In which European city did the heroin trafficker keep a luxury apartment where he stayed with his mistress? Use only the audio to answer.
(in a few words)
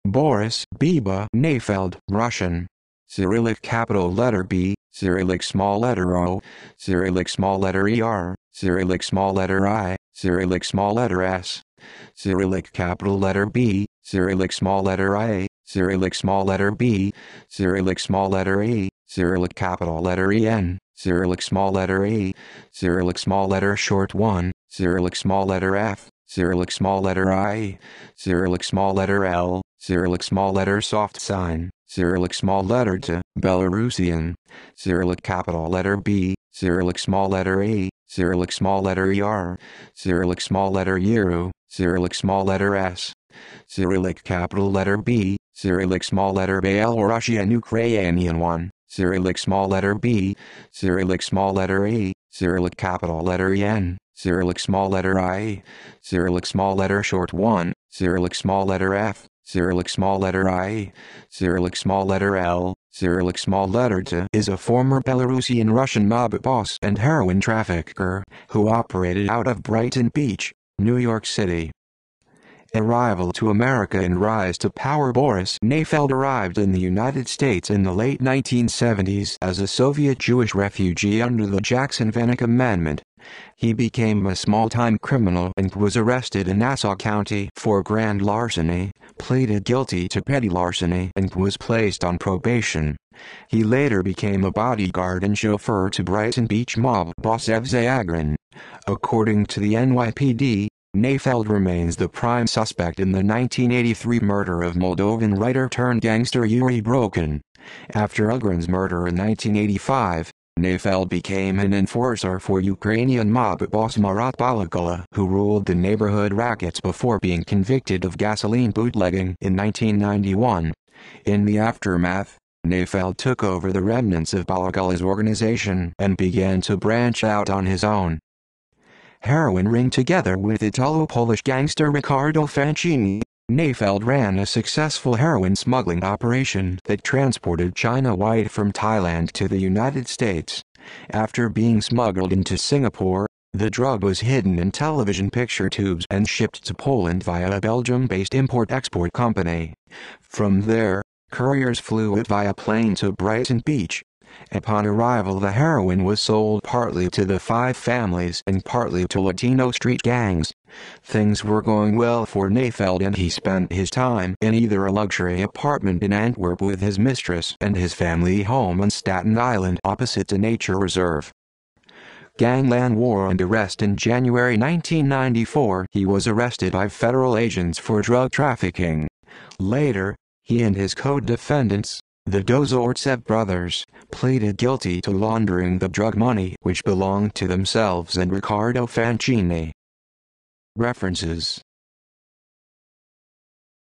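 Antwerp.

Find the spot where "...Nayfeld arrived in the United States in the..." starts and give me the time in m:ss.
1:15.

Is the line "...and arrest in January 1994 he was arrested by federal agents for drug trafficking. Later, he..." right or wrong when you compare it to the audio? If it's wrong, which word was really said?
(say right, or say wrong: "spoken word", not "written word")
right.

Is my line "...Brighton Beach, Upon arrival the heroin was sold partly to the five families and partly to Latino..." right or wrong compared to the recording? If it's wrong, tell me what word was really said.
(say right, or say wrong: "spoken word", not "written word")
right.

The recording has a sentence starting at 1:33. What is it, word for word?
He later became a bodyguard and chauffeur to Brighton Beach mob boss Evsei Agron.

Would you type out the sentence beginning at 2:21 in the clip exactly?
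After being smuggled into Singapore, the drug was hidden in television picture tubes and shipped to Poland via a Belgium-based import-export company.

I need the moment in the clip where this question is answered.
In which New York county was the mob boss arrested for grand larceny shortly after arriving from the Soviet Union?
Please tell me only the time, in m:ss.
1:26.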